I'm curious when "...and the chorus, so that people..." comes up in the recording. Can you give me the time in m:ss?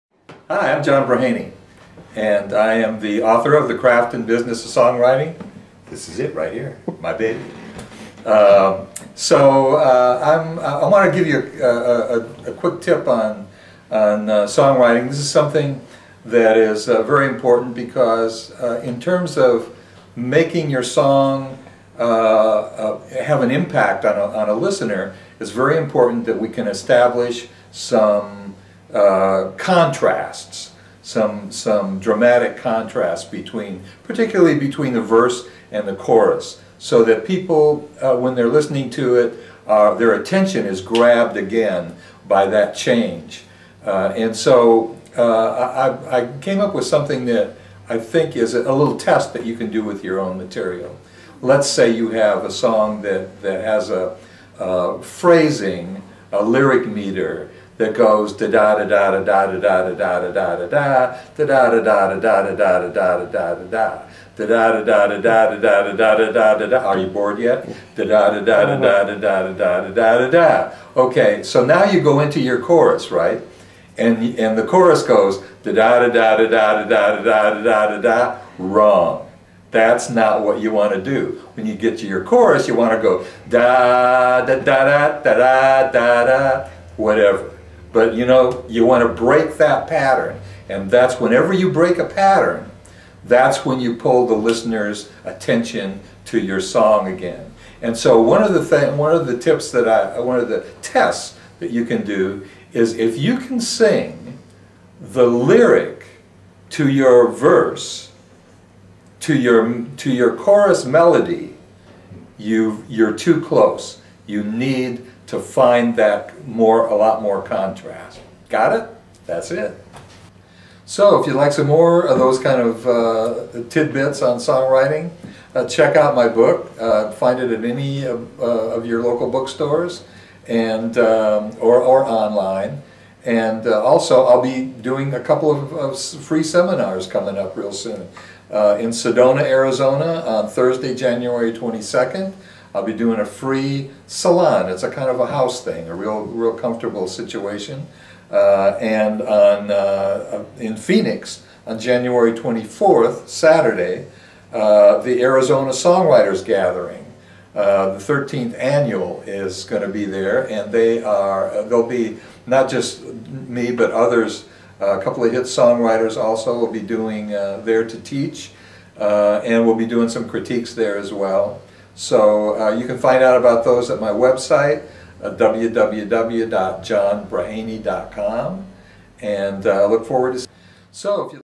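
0:35.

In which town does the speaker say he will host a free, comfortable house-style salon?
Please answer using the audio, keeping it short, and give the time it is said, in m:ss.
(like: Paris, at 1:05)
Sedona, at 2:18.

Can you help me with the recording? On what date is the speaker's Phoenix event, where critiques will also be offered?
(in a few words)
January 24.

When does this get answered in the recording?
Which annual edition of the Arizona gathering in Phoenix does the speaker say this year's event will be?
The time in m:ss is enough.
2:38.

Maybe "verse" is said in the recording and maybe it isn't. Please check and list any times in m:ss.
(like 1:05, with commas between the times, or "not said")
0:35, 1:47.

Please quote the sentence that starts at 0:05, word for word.
This is it right here, my baby.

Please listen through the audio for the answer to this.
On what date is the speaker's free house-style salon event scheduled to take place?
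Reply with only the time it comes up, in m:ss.
2:20.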